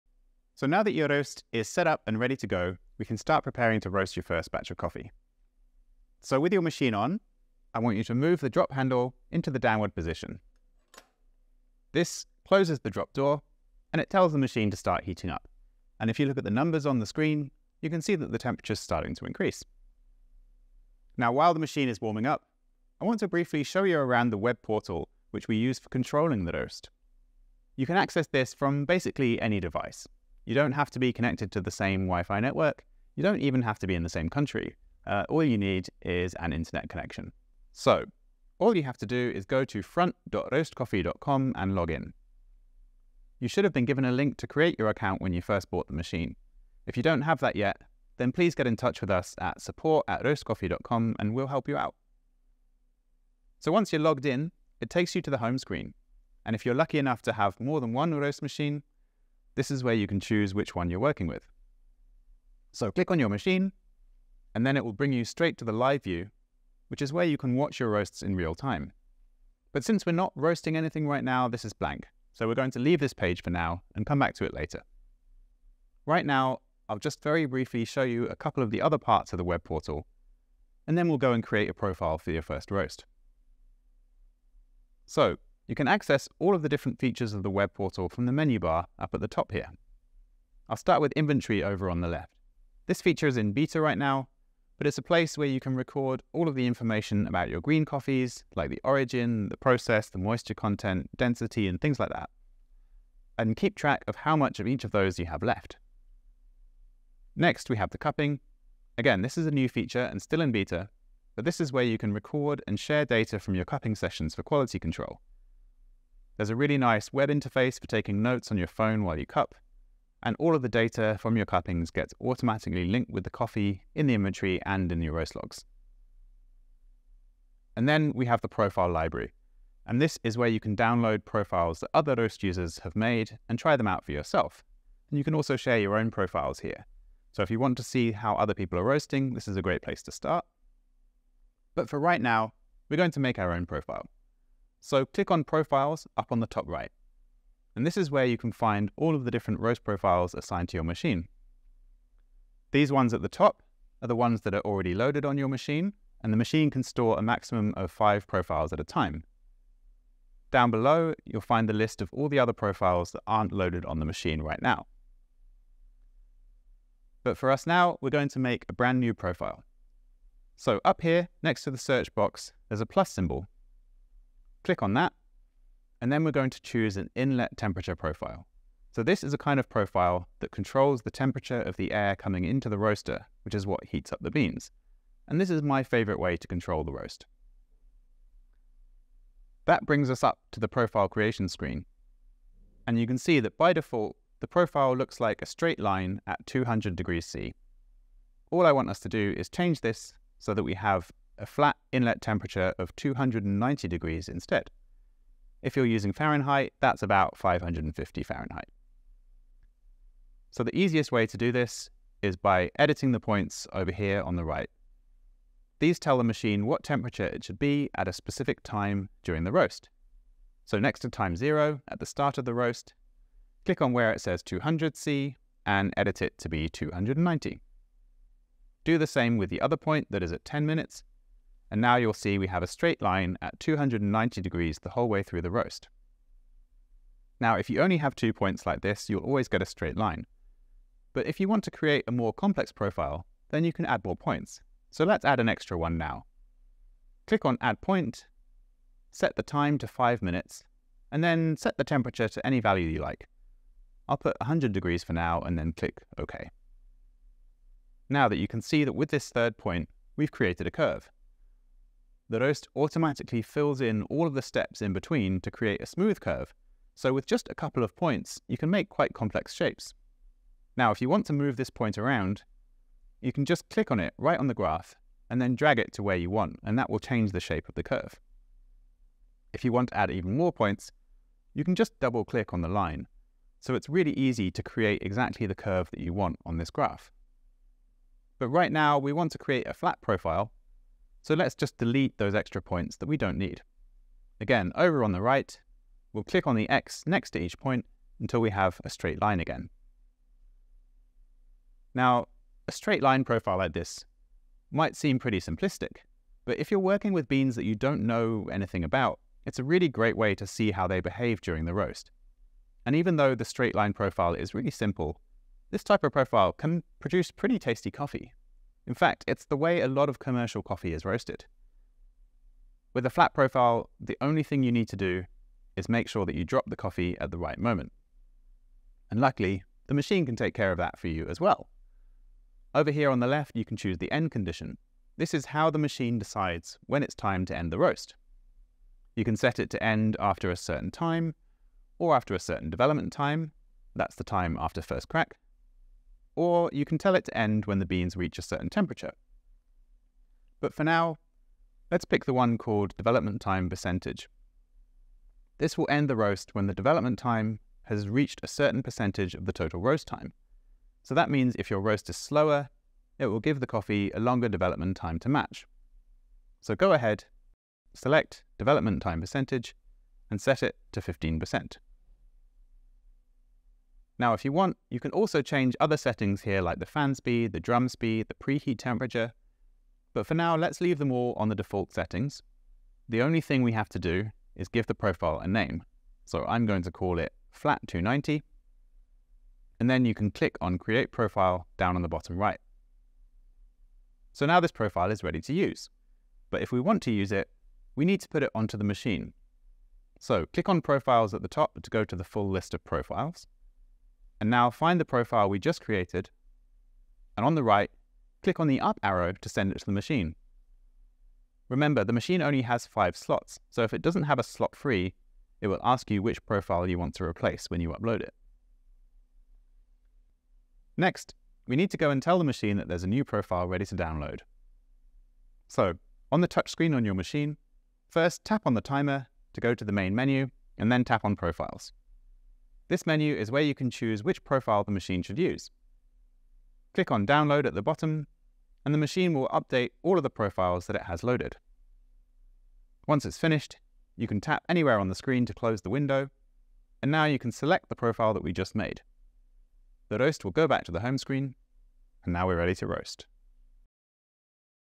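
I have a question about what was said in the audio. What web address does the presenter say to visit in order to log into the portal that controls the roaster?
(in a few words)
front.roestcoffee.com.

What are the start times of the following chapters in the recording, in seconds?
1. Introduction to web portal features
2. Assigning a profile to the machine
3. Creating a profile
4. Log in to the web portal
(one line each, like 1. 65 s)
1. 84 s
2. 394 s
3. 141 s
4. 38 s.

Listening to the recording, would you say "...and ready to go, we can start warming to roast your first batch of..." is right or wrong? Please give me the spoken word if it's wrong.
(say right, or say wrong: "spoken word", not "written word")
wrong: "preparing", not "warming".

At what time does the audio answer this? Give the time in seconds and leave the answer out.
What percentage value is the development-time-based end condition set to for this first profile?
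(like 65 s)
371 s.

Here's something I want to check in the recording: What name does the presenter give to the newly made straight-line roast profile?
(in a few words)
flat 290.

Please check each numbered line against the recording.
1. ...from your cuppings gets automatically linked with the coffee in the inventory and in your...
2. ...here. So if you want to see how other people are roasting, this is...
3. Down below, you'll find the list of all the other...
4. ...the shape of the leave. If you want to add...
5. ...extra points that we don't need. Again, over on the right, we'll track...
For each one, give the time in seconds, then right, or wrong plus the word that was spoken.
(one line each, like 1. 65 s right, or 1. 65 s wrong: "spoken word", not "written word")
1. 121 s right
2. 136 s right
3. 160 s right
4. 277 s wrong: "curve", not "leave"
5. 292 s wrong: "click", not "track".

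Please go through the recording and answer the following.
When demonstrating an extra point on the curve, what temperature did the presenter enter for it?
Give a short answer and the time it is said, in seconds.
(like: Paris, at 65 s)
100 degrees, at 254 s.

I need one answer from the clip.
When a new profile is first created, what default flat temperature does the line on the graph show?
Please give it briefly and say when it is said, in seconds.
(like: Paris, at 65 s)
200 degrees C, at 196 s.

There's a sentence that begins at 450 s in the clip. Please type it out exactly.
The ROEST will go back to the home screen, and now we're ready to roast.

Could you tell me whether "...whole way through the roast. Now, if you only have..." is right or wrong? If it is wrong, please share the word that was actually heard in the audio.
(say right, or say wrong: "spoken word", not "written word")
right.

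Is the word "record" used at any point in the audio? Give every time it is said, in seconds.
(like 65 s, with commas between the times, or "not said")
95 s, 112 s.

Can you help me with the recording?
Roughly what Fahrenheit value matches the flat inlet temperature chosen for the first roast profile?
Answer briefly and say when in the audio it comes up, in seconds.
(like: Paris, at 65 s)
550 Fahrenheit, at 207 s.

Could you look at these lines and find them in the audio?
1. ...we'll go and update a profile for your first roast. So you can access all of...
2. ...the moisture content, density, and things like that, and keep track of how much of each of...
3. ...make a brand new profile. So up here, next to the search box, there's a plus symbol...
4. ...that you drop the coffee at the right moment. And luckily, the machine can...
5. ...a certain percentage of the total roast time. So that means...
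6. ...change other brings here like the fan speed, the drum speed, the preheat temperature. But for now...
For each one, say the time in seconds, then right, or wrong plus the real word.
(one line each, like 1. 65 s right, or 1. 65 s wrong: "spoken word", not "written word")
1. 81 s wrong: "create", not "update"
2. 100 s right
3. 168 s right
4. 326 s right
5. 358 s right
6. 375 s wrong: "settings", not "brings".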